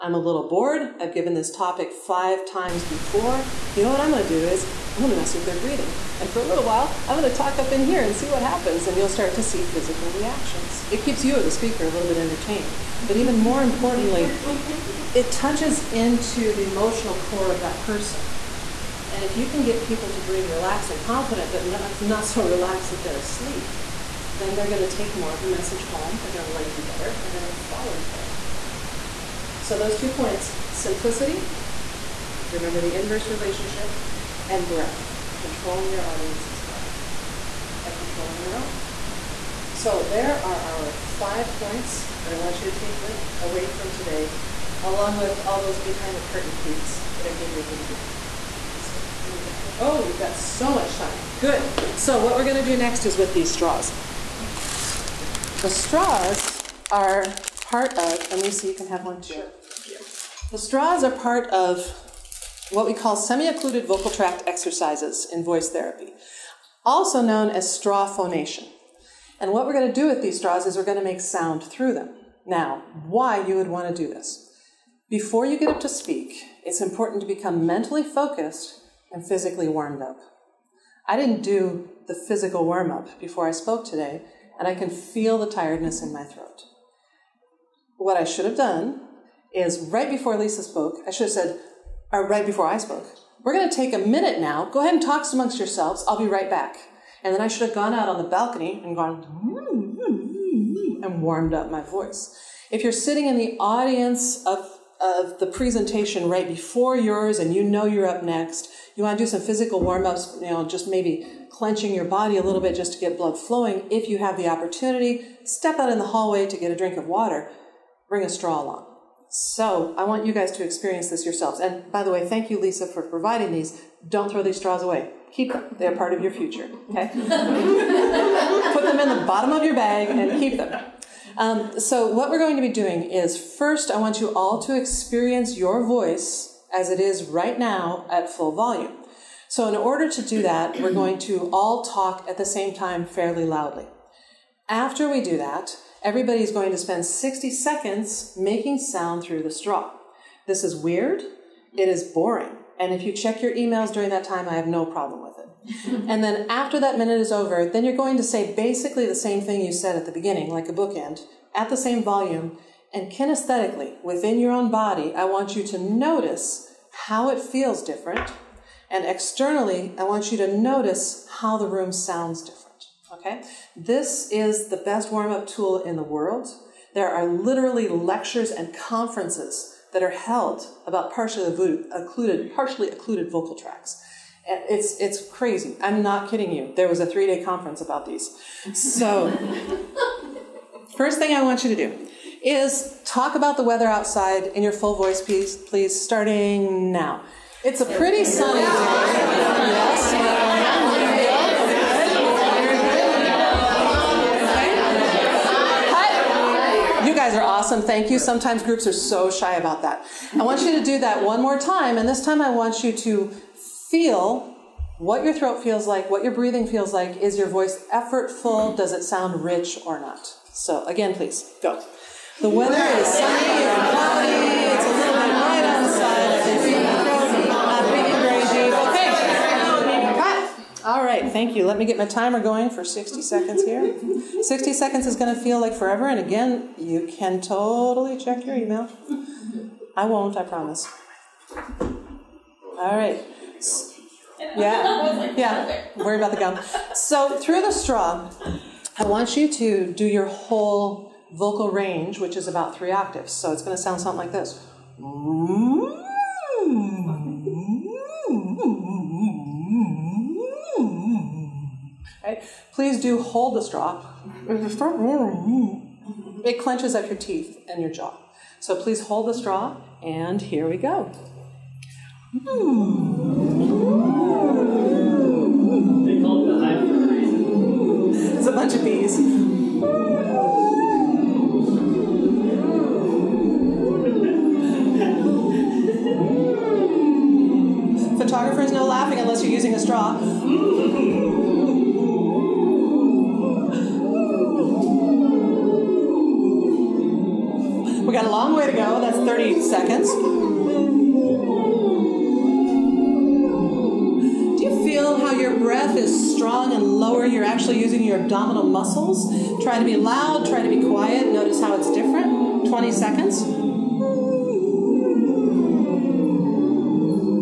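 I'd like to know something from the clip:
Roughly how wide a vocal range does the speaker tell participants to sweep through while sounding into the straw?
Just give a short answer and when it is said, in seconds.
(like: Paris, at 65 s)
3 octaves, at 252 s.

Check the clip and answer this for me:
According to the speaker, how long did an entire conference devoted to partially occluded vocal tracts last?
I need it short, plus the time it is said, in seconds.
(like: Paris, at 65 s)
3 days, at 187 s.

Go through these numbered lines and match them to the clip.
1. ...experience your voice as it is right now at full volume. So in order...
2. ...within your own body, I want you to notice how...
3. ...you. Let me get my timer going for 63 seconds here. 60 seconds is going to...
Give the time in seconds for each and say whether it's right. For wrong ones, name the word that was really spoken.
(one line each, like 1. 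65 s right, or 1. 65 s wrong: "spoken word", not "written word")
1. 134 s right
2. 164 s right
3. 231 s wrong: "60", not "63".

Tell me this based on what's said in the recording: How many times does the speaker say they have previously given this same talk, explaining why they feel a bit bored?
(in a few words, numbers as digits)
5.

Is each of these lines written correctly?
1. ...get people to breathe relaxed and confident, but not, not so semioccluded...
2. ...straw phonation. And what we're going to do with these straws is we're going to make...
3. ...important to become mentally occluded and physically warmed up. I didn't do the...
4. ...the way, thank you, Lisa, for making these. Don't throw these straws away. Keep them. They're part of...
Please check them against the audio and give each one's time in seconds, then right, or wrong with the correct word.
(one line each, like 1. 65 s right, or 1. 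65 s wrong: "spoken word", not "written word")
1. 19 s wrong: "relaxed", not "semioccluded"
2. 67 s right
3. 76 s wrong: "focused", not "occluded"
4. 122 s wrong: "providing", not "making".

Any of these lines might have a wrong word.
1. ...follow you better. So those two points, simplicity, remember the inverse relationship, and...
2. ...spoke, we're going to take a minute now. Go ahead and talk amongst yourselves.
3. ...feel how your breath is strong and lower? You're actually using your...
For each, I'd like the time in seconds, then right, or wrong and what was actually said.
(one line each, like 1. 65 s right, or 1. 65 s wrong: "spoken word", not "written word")
1. 27 s right
2. 92 s right
3. 304 s right.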